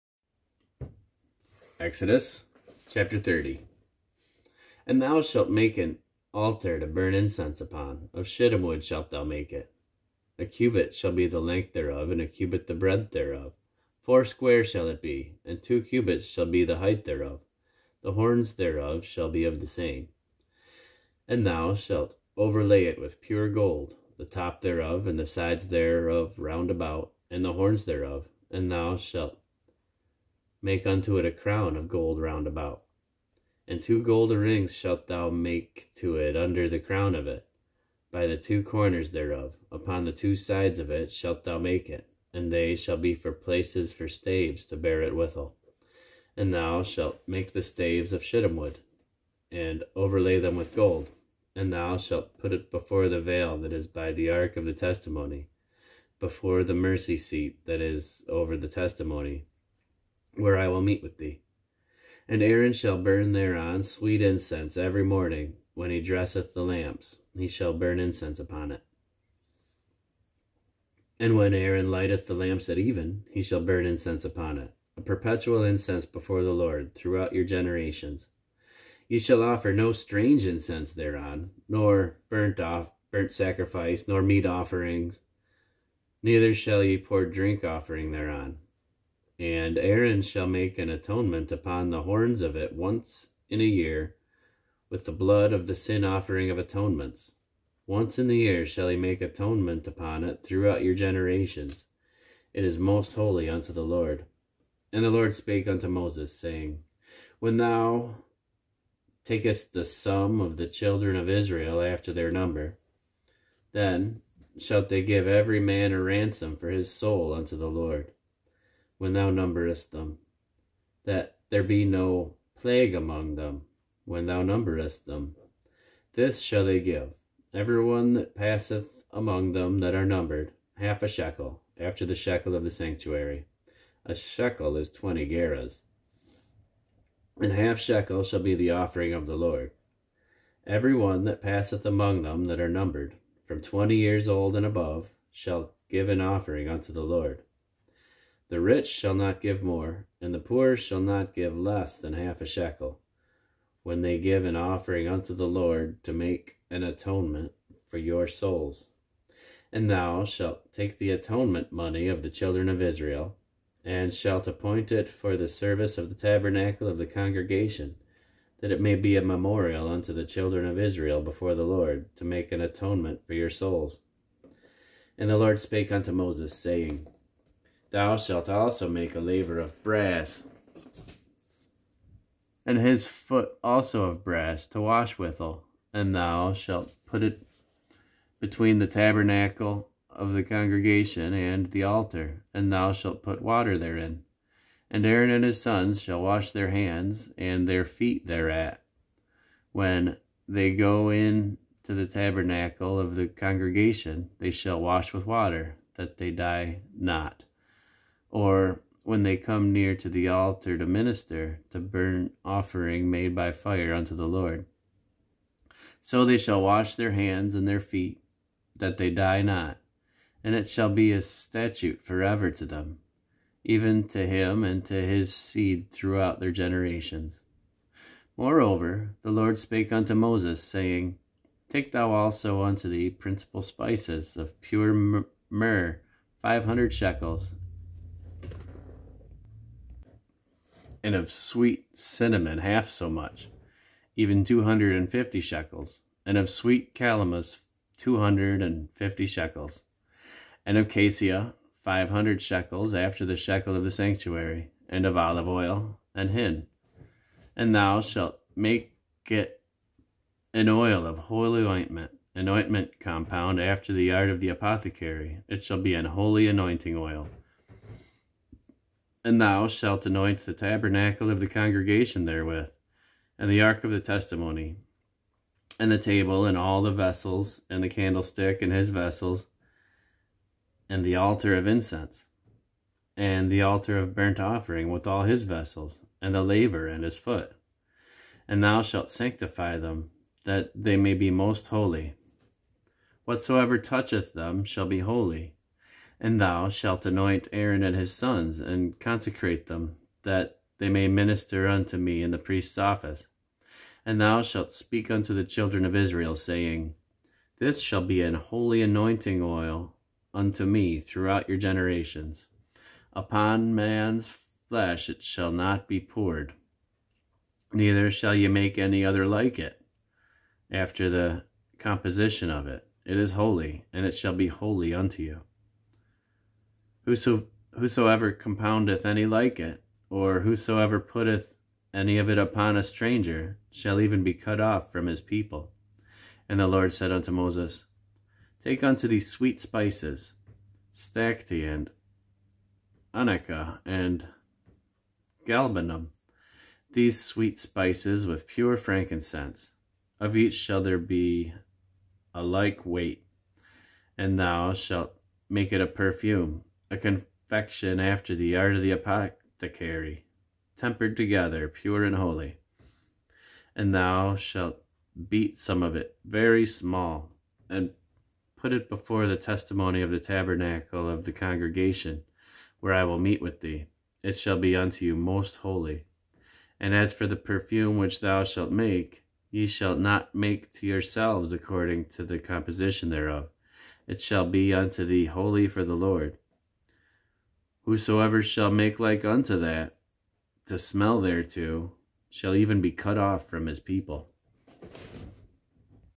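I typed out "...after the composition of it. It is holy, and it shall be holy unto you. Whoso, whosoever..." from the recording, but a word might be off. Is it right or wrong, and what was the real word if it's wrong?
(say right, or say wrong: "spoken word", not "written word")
right.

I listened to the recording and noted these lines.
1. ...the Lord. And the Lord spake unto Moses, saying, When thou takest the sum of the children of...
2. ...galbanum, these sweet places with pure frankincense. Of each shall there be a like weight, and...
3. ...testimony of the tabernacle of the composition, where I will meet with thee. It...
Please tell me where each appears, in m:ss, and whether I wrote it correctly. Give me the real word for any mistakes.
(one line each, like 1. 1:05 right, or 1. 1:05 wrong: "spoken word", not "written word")
1. 1:43 right
2. 5:45 wrong: "spices", not "places"
3. 6:09 wrong: "congregation", not "composition".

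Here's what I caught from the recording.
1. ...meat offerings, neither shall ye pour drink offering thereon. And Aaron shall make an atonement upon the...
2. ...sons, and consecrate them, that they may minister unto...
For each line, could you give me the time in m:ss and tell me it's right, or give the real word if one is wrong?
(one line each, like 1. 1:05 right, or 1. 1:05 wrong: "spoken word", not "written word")
1. 1:24 right
2. 4:58 right.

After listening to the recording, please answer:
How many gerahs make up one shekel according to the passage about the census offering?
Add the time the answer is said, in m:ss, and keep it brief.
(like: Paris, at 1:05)
20, at 2:14.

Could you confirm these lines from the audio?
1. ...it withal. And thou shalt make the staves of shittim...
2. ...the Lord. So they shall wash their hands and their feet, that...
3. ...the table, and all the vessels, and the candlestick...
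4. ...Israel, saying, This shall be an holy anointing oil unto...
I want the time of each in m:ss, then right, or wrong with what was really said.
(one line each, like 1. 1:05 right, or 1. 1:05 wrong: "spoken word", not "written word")
1. 0:45 right
2. 3:34 right
3. 4:35 right
4. 5:05 right.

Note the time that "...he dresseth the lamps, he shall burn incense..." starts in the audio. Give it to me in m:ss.
1:05.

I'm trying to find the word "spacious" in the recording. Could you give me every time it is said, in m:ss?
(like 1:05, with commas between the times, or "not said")
not said.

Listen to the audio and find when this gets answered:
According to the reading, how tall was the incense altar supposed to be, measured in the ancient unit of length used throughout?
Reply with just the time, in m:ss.
0:15.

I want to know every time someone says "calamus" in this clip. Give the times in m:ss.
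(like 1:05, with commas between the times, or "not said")
4:06.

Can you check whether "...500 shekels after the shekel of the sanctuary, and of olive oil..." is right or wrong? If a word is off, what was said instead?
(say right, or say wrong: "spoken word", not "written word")
right.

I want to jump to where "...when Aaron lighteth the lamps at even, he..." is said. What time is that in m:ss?
1:11.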